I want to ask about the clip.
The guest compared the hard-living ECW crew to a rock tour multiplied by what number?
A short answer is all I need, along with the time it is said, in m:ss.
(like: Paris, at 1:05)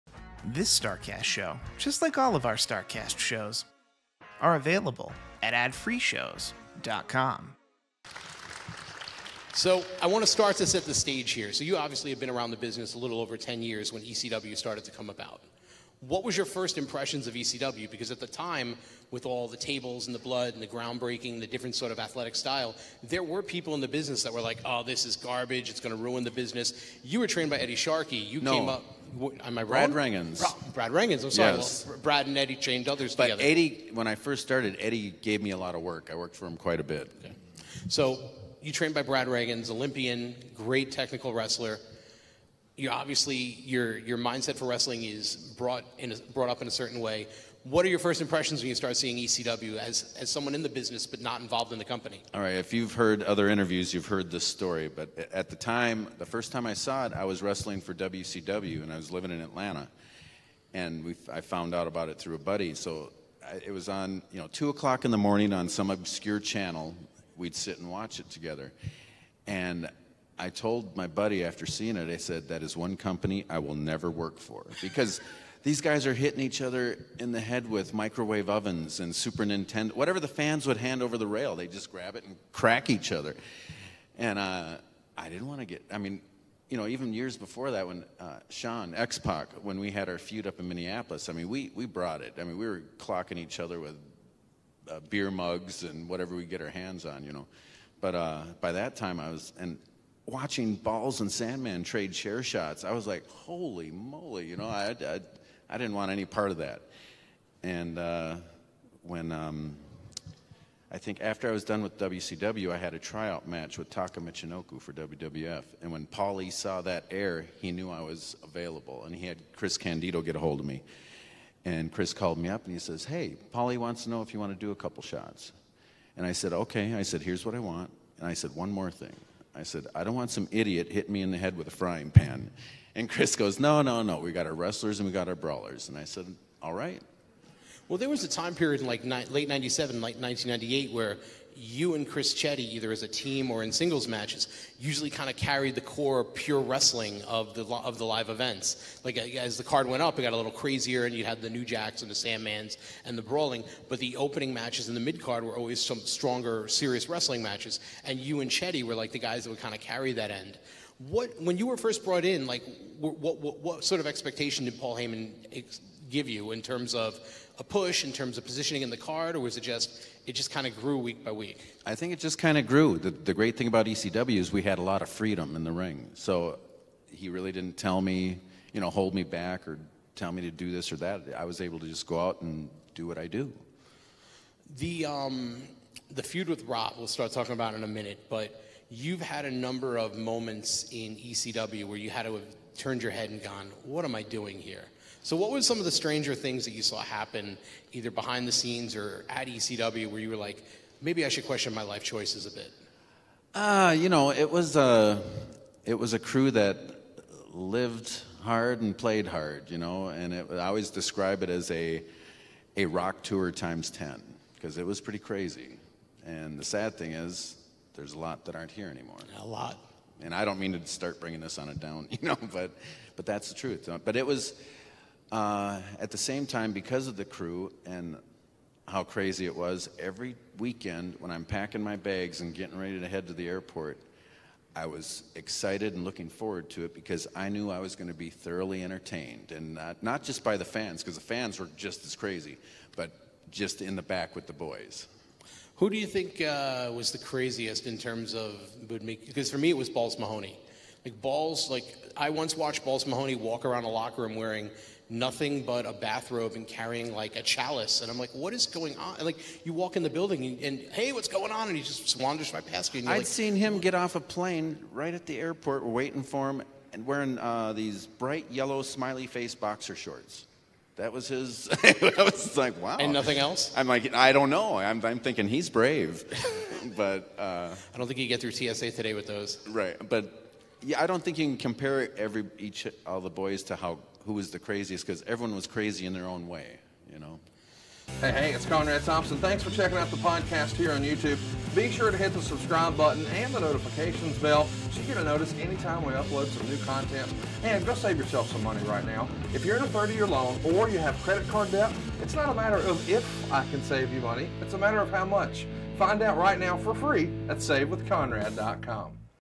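10, at 3:33.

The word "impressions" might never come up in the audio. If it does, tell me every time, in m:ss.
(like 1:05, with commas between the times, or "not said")
0:16, 0:48.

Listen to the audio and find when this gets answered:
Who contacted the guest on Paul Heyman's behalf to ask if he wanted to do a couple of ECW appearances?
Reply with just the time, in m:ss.
1:59.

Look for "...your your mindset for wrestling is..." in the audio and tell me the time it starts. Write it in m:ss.
0:43.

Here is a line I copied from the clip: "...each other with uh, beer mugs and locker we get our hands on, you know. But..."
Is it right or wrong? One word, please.
wrong.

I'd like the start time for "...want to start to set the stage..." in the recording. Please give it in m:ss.
0:10.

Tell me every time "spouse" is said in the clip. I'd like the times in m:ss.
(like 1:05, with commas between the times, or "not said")
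not said.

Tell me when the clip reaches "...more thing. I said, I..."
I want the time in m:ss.
2:08.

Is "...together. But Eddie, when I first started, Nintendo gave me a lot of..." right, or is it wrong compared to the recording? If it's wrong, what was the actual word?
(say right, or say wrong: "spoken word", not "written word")
wrong: "Eddie", not "Nintendo".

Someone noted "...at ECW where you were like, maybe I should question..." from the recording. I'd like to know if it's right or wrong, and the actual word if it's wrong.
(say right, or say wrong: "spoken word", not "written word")
right.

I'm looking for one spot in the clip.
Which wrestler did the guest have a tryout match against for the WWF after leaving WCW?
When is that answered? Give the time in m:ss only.
1:53.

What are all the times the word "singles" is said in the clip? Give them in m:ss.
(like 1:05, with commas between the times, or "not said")
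2:23.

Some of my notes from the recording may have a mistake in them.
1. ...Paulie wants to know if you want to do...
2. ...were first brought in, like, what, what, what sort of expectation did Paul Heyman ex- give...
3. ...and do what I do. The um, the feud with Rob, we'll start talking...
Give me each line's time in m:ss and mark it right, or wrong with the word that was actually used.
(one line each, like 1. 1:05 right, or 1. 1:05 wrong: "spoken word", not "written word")
1. 2:03 right
2. 2:41 right
3. 3:02 right.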